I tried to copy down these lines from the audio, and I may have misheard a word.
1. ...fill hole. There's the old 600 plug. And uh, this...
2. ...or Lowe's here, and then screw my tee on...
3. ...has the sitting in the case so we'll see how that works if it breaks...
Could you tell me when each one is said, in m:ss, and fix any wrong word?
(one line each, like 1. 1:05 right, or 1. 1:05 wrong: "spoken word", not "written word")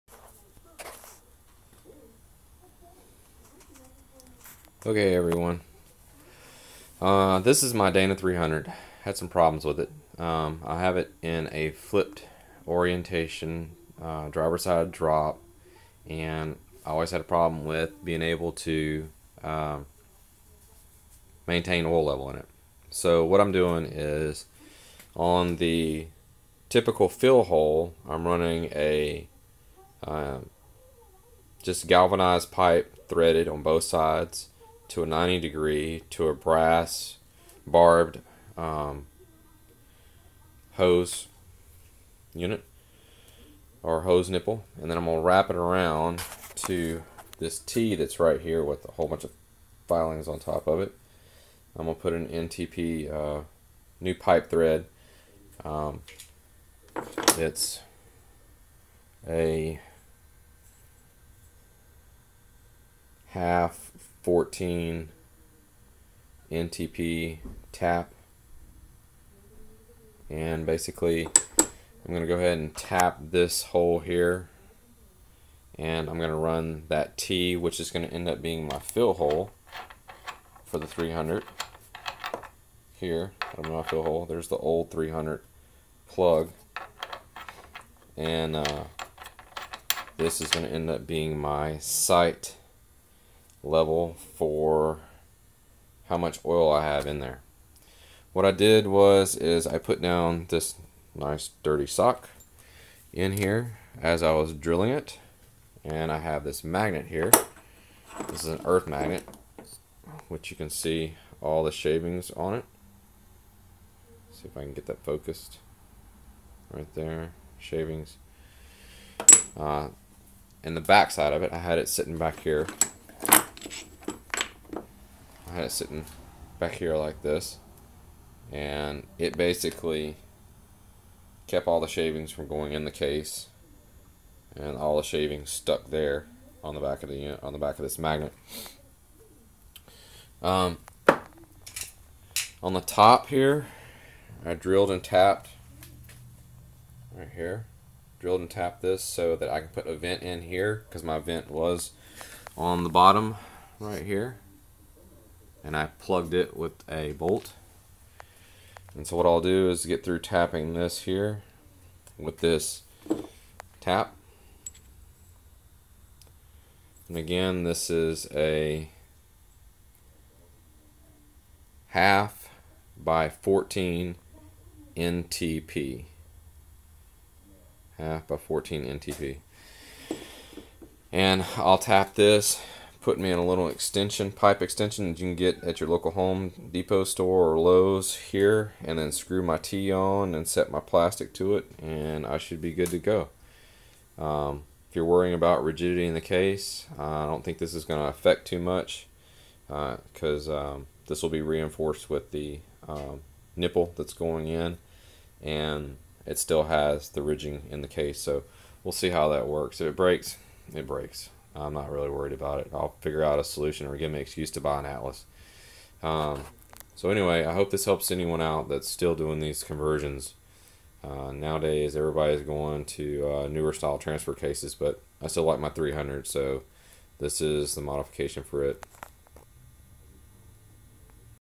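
1. 1:23 wrong: "300", not "600"
2. 3:07 right
3. 3:26 wrong: "ridging", not "sitting".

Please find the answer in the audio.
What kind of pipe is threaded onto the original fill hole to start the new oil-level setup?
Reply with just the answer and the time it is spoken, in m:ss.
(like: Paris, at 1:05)
galvanized pipe, at 0:31.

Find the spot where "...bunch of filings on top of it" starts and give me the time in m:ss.
0:49.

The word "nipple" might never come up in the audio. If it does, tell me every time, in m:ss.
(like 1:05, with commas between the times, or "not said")
0:44, 3:23.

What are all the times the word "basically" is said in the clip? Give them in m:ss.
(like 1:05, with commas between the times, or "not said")
1:10, 2:09.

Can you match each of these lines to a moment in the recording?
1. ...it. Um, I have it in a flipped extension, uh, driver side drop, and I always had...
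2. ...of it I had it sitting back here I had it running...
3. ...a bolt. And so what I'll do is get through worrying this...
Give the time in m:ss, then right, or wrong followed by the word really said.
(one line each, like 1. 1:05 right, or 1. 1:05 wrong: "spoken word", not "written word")
1. 0:09 wrong: "orientation", not "extension"
2. 2:01 wrong: "sitting", not "running"
3. 2:36 wrong: "tapping", not "worrying".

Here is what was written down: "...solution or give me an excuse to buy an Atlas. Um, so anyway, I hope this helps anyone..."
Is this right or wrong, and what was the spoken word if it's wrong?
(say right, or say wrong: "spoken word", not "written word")
right.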